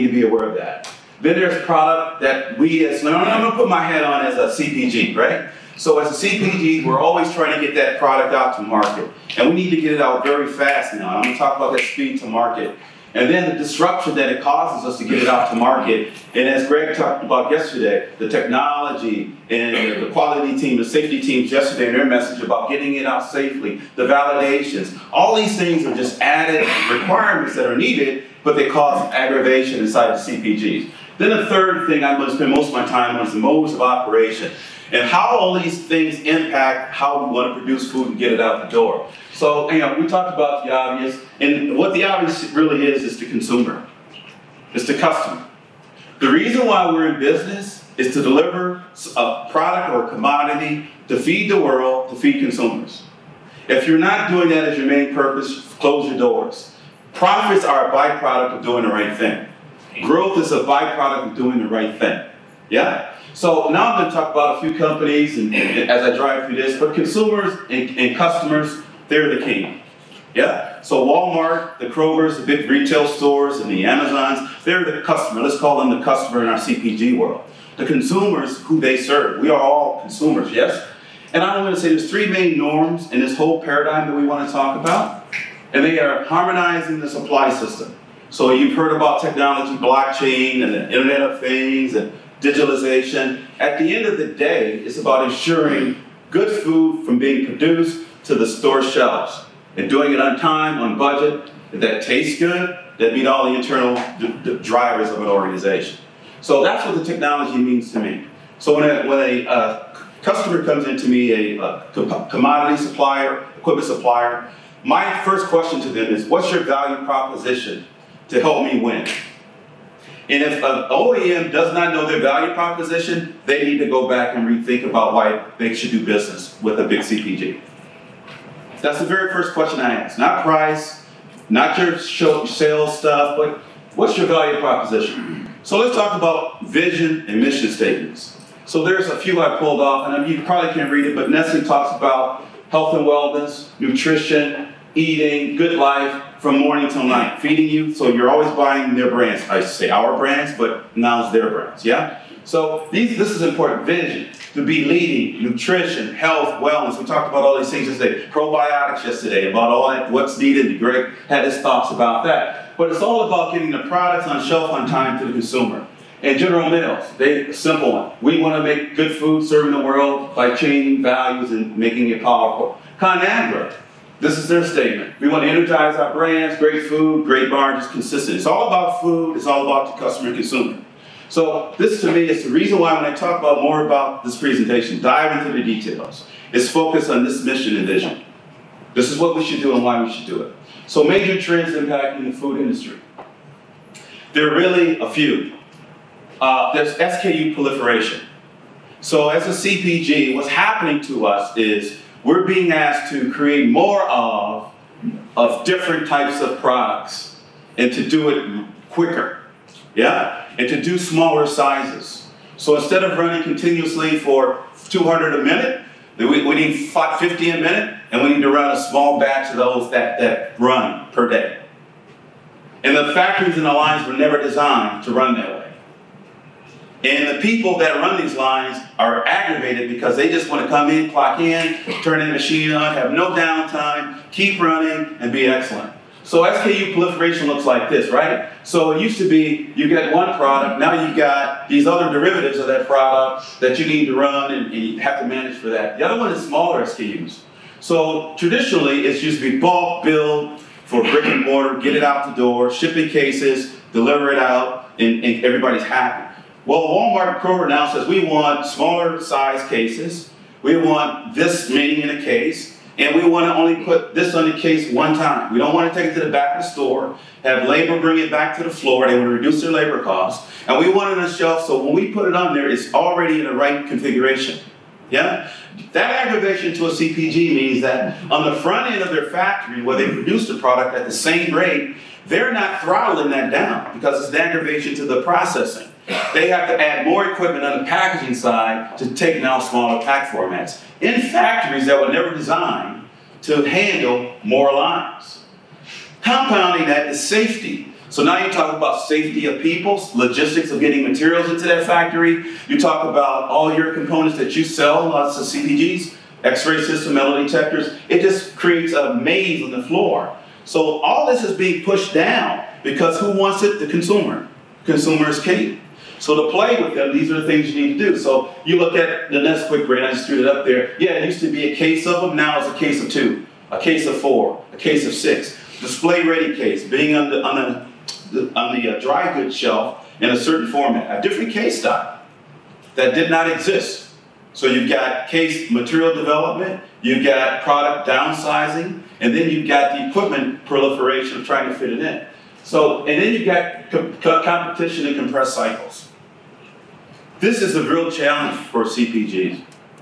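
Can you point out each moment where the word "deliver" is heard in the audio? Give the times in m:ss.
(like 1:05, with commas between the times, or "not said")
0:48, 4:13.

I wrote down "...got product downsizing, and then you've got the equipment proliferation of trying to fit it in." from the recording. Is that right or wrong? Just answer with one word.
right.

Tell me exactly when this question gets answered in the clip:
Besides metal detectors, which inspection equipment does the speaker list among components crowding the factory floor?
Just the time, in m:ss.
5:06.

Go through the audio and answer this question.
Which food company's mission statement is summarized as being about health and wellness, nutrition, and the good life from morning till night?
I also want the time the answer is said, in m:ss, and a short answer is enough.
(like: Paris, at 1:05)
Nestle, at 2:21.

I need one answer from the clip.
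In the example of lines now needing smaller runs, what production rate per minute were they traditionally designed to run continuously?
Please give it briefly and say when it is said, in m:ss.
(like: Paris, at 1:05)
200 a minute, at 3:34.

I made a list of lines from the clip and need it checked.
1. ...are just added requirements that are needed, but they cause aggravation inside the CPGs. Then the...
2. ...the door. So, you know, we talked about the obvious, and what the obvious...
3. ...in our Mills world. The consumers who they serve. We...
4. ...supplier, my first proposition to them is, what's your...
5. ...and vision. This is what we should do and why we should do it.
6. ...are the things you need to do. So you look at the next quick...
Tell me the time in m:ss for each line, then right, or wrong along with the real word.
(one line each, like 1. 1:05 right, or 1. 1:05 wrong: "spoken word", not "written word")
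1. 0:25 right
2. 0:38 right
3. 1:16 wrong: "CPG", not "Mills"
4. 1:53 wrong: "question", not "proposition"
5. 3:07 right
6. 5:17 right.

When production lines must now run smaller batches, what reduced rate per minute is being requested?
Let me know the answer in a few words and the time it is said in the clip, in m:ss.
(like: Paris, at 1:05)
50 a minute, at 3:36.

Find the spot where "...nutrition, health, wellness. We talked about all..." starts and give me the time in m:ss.
2:35.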